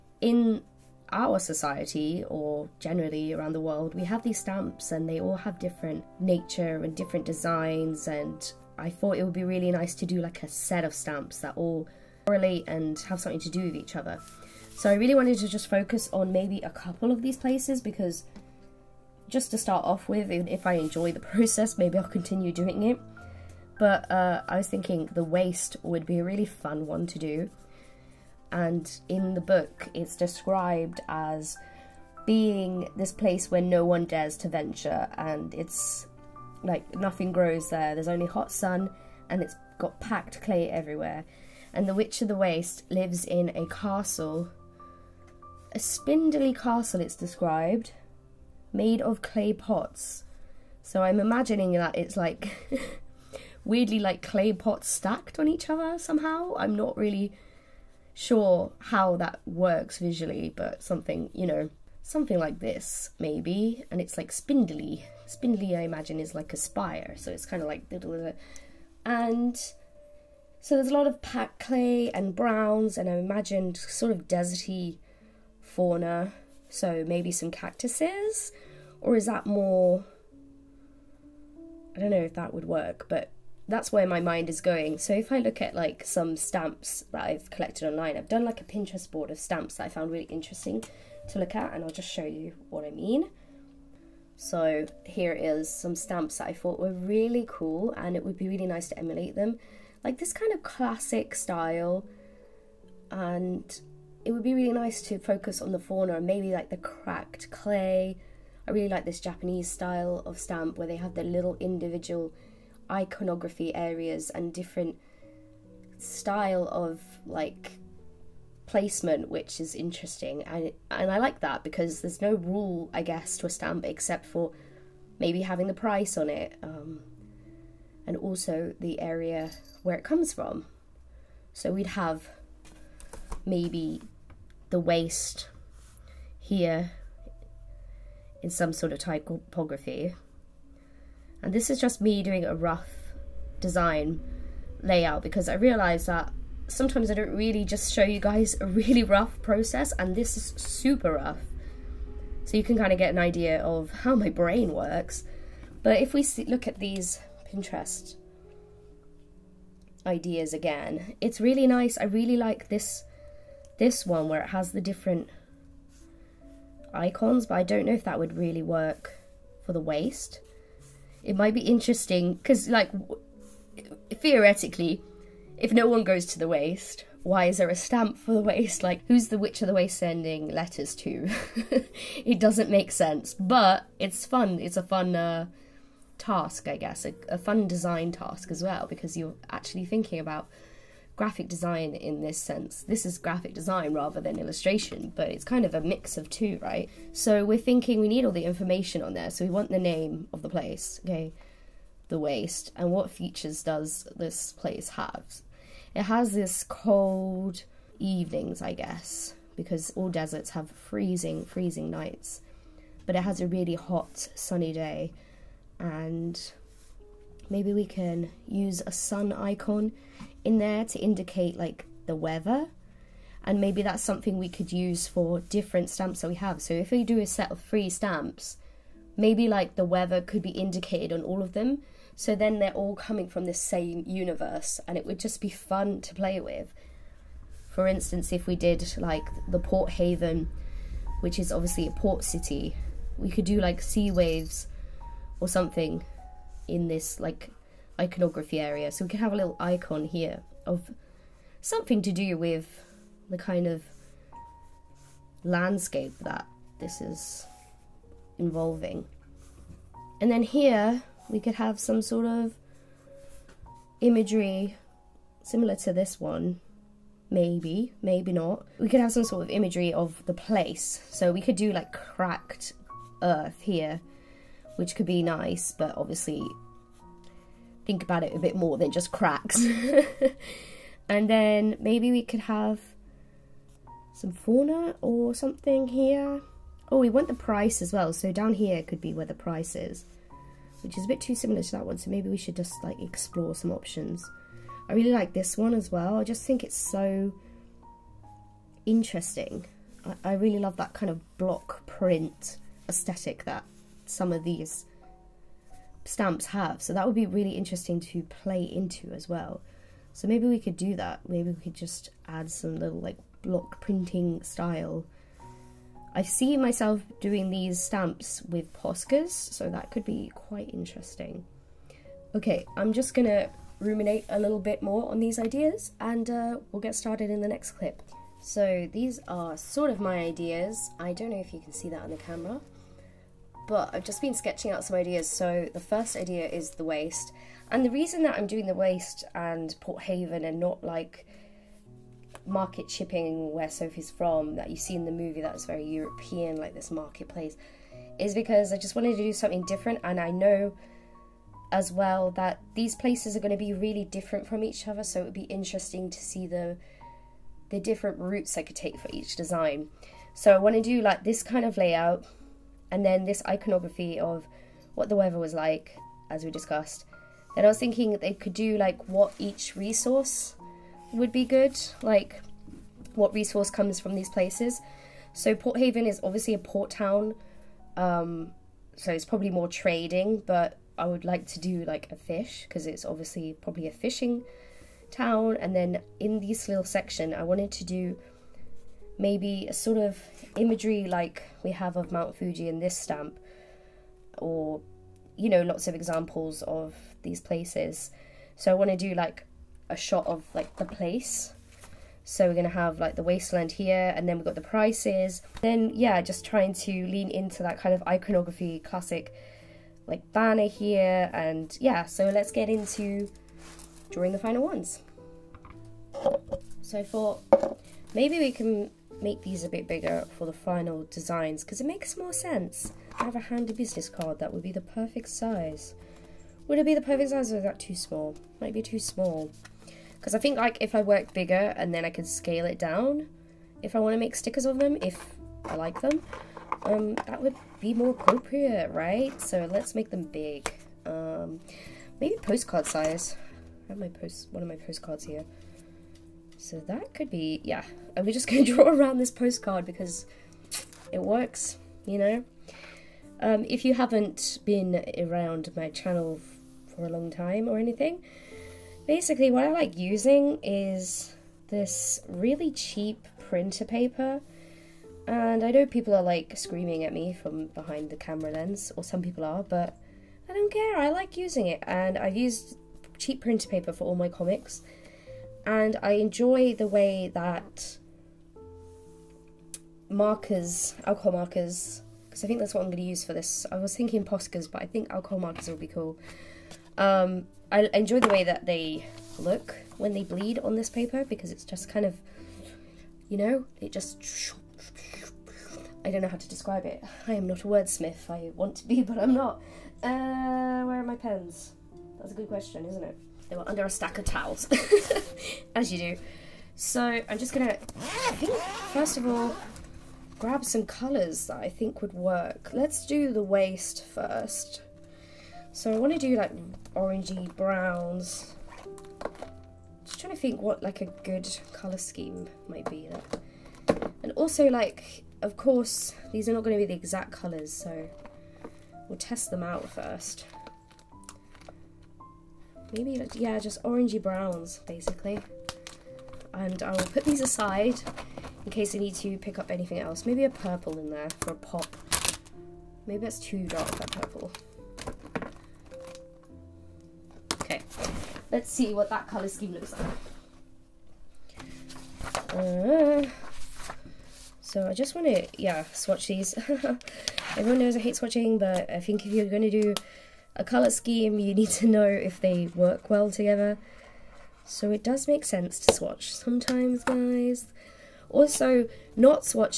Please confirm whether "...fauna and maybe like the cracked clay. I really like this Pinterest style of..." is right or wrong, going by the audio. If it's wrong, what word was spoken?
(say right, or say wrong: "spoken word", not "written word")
wrong: "Japanese", not "Pinterest".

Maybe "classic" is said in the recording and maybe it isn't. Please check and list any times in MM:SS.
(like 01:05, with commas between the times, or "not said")
01:40, 06:48.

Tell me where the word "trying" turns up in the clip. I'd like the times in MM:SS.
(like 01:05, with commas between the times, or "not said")
06:46, 08:40.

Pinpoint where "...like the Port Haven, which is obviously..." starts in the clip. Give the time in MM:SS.
03:58.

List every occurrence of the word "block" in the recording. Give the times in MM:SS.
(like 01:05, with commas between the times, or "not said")
05:01, 05:13.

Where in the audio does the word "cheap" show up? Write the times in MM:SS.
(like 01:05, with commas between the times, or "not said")
07:42, 07:53.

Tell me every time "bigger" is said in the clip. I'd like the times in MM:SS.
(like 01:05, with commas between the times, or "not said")
06:59, 07:11.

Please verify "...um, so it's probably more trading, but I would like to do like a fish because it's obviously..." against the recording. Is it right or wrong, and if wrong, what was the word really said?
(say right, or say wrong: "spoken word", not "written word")
right.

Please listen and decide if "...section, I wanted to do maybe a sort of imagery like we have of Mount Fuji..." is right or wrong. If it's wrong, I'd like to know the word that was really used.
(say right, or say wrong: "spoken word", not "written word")
right.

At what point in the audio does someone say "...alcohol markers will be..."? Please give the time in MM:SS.
08:05.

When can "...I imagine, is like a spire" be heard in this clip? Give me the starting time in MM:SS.
01:05.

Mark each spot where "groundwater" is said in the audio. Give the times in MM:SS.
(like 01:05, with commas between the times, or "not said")
not said.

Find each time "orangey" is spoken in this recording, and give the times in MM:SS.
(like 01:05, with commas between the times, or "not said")
08:36, 08:53.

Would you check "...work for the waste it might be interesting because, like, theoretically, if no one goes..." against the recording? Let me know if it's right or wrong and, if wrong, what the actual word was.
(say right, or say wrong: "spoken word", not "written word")
right.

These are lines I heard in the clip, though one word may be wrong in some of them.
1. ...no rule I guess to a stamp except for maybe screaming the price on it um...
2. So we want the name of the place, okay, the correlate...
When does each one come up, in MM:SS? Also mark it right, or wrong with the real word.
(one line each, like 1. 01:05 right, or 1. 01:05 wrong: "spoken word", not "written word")
1. 02:02 wrong: "having", not "screaming"
2. 03:19 wrong: "waste", not "correlate".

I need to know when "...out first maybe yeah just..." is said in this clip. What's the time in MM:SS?
08:49.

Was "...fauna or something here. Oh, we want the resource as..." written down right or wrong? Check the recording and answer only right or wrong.
wrong.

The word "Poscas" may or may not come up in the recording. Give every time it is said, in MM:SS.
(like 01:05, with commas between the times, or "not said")
05:18, 08:04.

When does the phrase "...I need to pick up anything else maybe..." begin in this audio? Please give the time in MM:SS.
08:58.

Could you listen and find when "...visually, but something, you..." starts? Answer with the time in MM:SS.
00:59.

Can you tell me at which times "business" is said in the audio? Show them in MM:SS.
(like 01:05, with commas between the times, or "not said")
07:03.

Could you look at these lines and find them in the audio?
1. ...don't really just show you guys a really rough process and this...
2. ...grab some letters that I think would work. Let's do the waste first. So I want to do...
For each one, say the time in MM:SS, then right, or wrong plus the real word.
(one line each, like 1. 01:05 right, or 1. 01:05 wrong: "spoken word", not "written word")
1. 02:27 right
2. 08:30 wrong: "colours", not "letters".